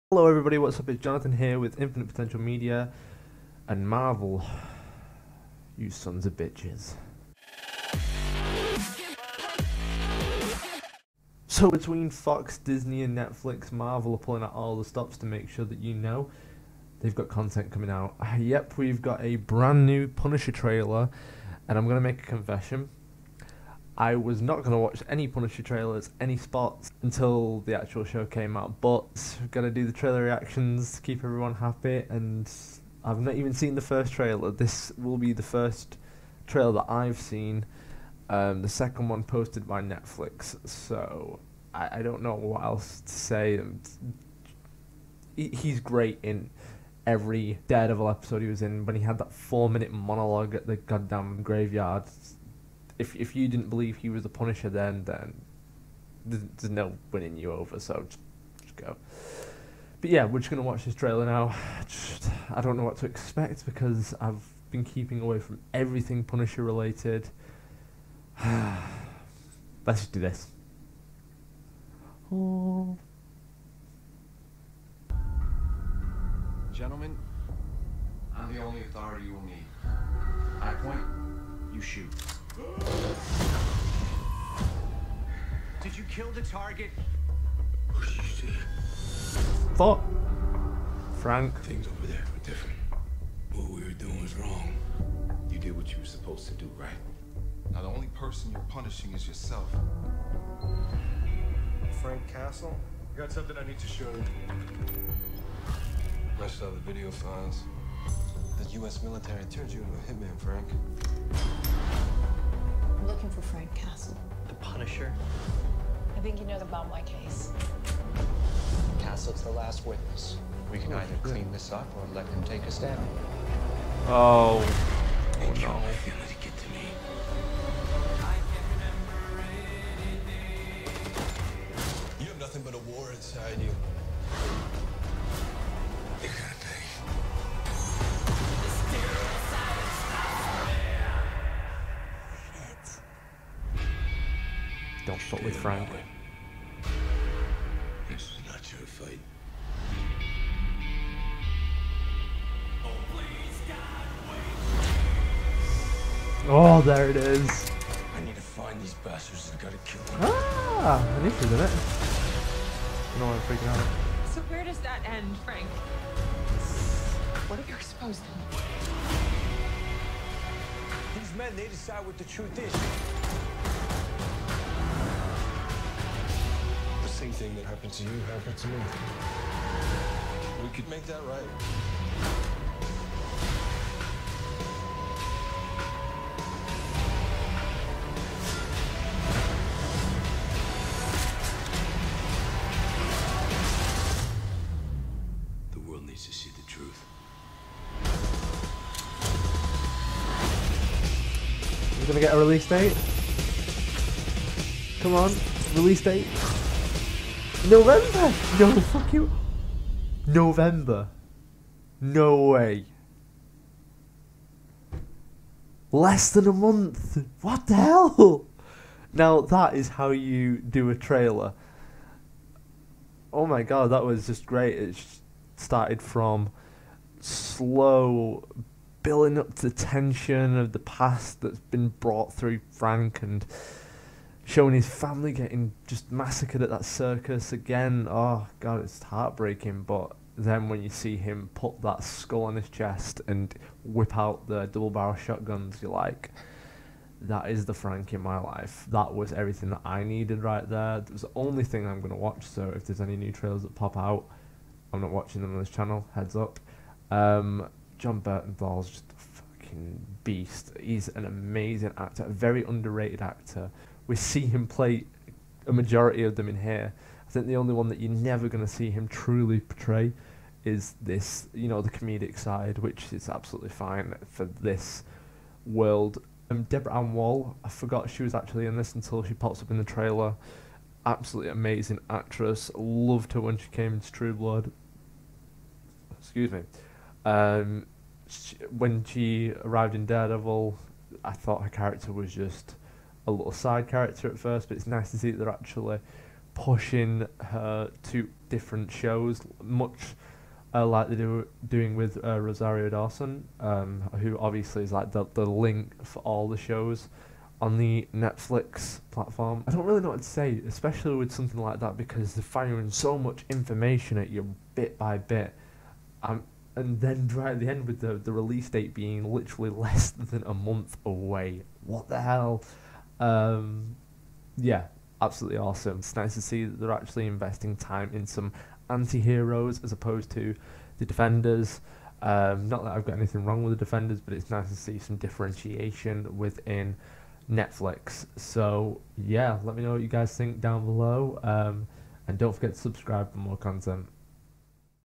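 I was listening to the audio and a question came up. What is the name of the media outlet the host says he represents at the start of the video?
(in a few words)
Infinite Potential Media.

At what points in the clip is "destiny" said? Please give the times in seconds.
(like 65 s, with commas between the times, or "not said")
not said.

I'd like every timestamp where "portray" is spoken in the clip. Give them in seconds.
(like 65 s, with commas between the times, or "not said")
269 s.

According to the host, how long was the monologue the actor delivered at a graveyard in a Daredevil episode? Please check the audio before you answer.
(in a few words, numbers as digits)
4 minutes.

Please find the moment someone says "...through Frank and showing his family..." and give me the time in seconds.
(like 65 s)
232 s.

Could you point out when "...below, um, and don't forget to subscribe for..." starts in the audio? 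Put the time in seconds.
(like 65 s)
340 s.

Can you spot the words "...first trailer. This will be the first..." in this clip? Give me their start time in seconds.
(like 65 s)
33 s.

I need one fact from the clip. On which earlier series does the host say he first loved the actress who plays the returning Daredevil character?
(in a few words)
True Blood.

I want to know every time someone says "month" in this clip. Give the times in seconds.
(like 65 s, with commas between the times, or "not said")
216 s, 320 s.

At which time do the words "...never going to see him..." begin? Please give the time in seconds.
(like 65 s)
268 s.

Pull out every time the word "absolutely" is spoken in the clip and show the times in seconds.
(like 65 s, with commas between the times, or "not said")
273 s, 281 s, 325 s.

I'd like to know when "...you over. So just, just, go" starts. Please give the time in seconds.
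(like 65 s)
57 s.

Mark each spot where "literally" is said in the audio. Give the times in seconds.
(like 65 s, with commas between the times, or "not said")
319 s.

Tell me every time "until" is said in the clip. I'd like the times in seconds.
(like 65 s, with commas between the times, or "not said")
27 s, 278 s.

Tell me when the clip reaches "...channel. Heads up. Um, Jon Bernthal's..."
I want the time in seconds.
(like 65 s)
255 s.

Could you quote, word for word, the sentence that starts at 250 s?
It was the only thing I'm gonna watch.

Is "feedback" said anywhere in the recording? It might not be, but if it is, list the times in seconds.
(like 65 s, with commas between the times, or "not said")
not said.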